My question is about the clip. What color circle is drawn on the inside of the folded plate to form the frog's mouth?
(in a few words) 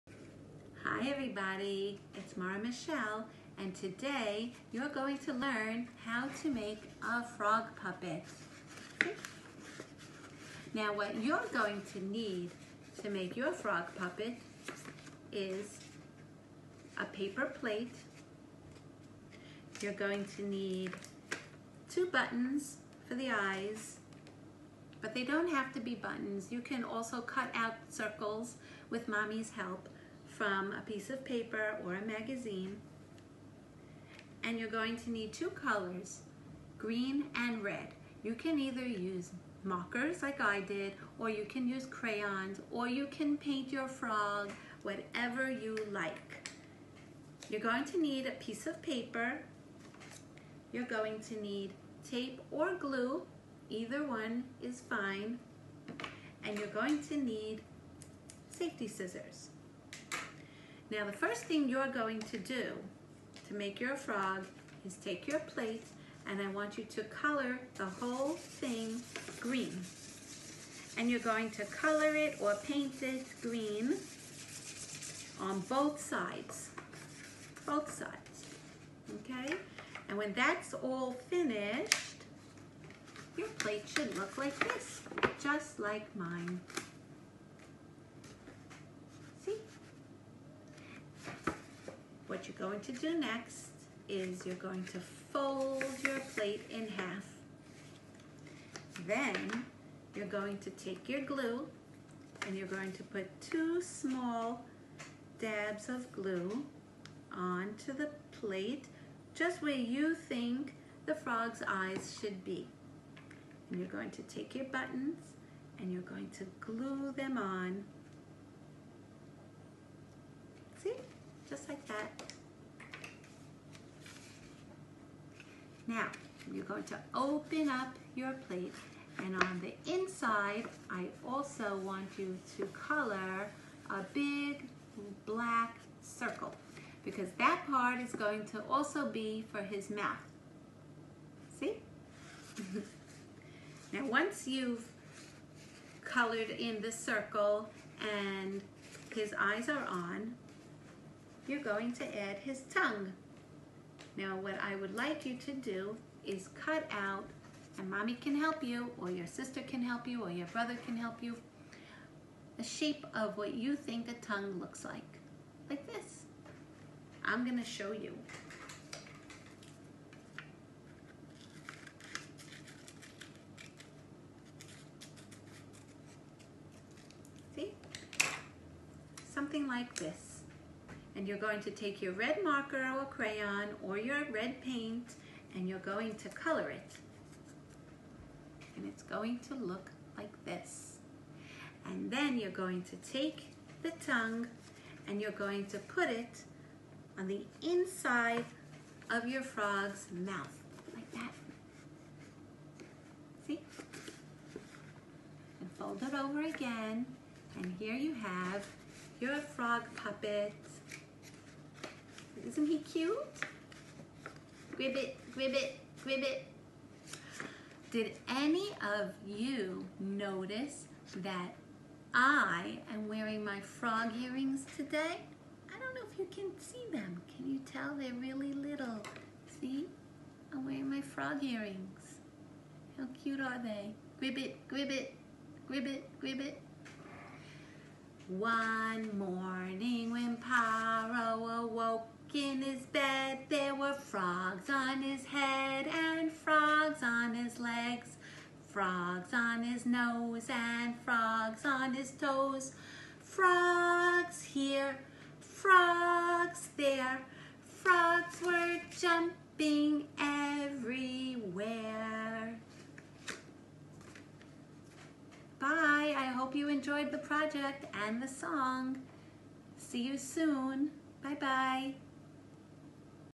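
black.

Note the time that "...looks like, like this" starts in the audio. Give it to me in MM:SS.
02:44.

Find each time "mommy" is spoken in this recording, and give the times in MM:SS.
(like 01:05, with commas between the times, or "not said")
00:29, 02:37.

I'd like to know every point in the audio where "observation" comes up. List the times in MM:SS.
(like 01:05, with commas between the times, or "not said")
not said.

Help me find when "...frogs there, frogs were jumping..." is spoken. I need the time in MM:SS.
04:15.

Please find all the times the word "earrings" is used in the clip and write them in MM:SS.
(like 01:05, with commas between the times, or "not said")
03:44, 03:51.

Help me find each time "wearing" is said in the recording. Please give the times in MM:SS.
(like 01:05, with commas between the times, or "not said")
03:43, 03:50.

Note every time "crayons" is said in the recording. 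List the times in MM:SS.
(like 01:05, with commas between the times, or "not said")
00:41, 03:03.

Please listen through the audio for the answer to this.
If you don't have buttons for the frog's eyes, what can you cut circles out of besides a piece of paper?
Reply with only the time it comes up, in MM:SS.
00:31.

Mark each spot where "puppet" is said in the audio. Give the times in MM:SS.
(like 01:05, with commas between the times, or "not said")
00:07, 00:13, 03:29.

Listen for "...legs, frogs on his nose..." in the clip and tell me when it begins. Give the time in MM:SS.
04:07.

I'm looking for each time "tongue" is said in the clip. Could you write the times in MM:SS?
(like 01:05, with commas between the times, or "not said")
02:32, 02:44, 03:14.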